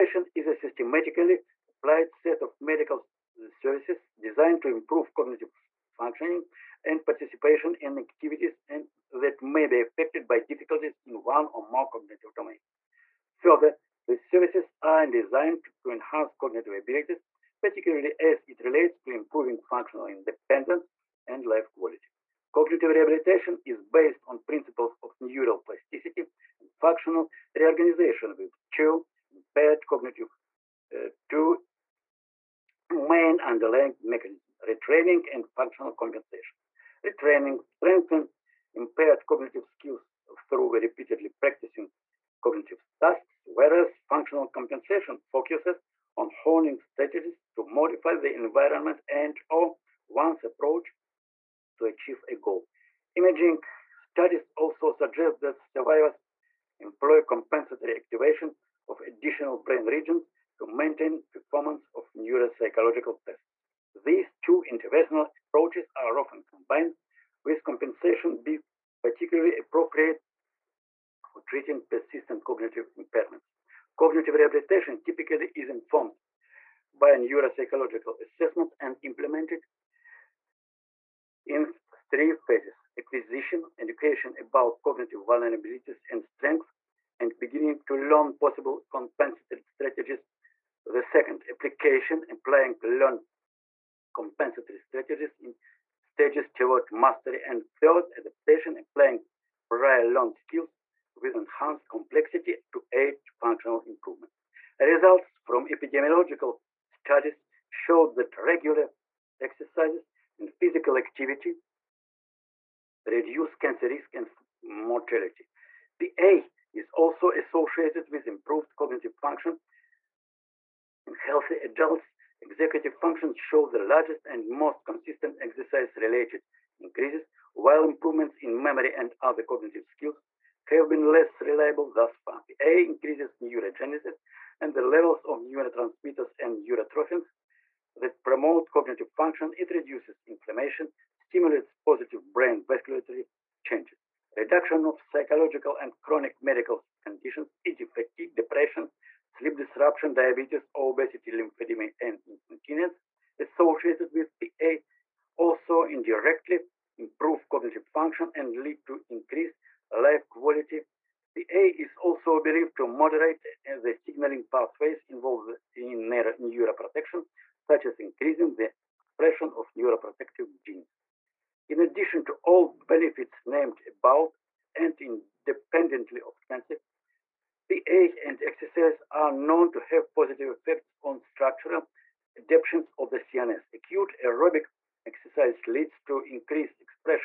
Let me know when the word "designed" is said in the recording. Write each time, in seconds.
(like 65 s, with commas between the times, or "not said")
4 s, 15 s.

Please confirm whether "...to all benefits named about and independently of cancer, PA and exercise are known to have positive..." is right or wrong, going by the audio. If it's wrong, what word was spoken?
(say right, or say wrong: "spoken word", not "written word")
right.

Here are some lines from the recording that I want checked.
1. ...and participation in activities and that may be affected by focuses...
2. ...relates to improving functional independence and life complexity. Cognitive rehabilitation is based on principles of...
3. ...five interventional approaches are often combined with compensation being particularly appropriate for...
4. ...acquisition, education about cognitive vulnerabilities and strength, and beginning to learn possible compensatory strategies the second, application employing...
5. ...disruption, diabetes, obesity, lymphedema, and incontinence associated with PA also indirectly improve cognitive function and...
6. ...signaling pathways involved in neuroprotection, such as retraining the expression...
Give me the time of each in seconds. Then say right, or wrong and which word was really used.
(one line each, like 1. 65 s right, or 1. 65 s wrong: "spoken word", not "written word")
1. 6 s wrong: "difficulties", not "focuses"
2. 18 s wrong: "quality", not "complexity"
3. 64 s wrong: "two", not "five"
4. 82 s right
5. 149 s right
6. 163 s wrong: "increasing", not "retraining".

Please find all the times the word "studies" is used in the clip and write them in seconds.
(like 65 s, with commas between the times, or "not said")
53 s, 106 s.